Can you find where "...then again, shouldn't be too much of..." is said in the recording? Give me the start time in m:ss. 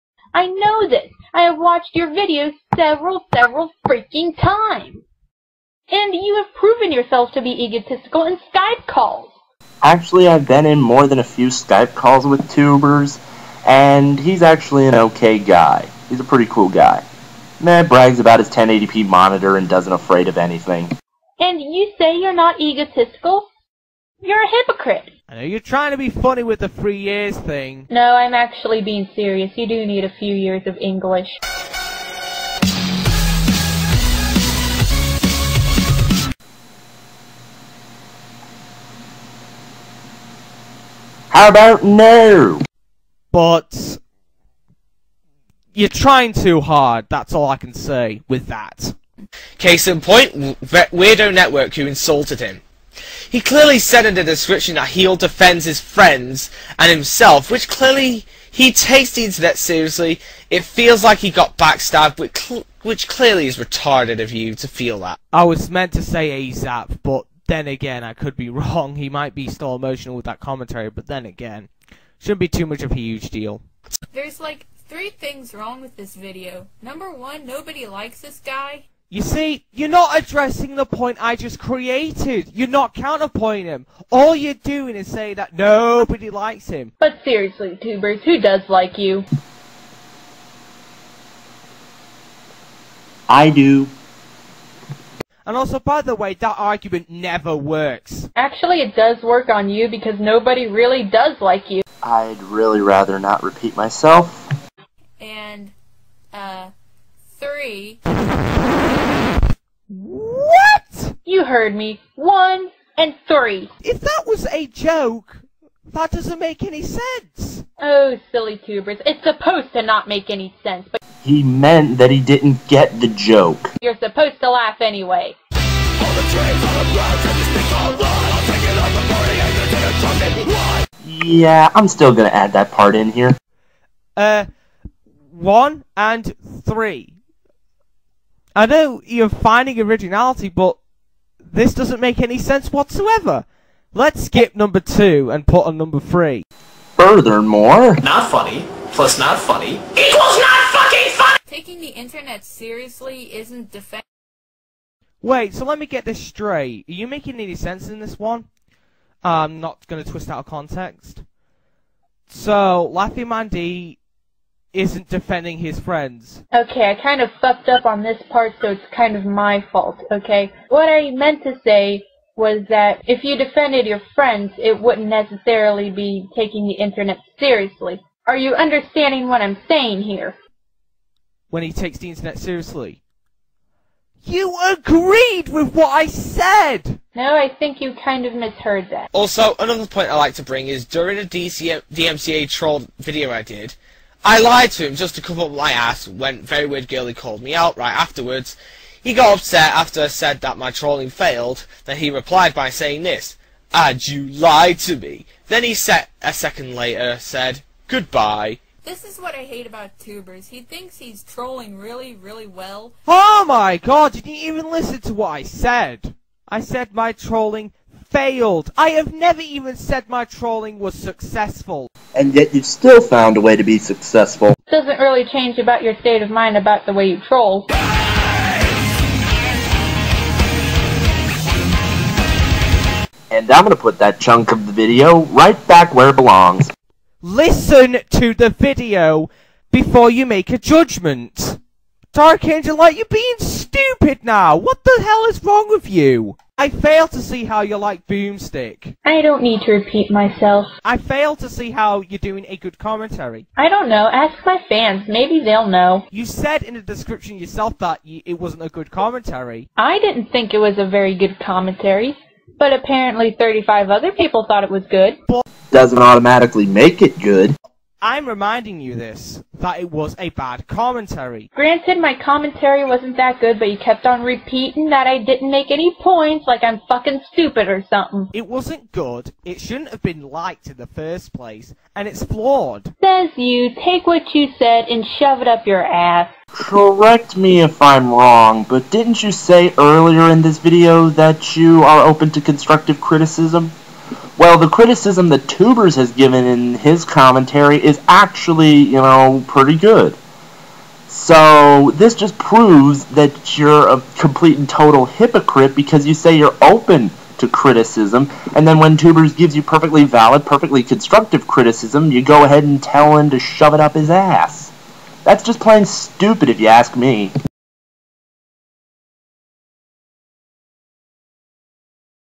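1:11.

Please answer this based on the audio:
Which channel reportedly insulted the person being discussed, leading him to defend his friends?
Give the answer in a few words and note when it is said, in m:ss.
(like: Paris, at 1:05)
Weirdo Network, at 0:50.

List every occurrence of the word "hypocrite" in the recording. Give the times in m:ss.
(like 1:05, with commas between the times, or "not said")
0:24, 5:05.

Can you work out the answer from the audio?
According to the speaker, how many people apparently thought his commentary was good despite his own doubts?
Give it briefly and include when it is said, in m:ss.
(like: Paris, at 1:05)
35, at 4:23.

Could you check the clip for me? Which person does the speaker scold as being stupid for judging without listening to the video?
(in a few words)
Dark Angel Light.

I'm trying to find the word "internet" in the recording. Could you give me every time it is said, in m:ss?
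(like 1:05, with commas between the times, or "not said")
0:59, 2:31, 2:56, 3:02.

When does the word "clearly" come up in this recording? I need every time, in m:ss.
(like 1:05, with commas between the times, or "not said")
0:53, 0:57, 1:03.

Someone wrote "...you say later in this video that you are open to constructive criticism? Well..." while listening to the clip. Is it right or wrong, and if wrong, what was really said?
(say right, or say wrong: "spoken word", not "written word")
wrong: "earlier", not "later".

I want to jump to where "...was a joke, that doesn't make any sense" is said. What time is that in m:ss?
1:54.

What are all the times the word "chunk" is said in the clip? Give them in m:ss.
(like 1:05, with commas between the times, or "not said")
3:54.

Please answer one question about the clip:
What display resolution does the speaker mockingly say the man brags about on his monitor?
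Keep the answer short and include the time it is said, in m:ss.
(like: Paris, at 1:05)
1080p, at 0:18.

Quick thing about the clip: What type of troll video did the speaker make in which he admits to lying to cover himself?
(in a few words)
DMCA troll video.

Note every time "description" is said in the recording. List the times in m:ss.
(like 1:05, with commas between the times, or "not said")
0:54, 4:16.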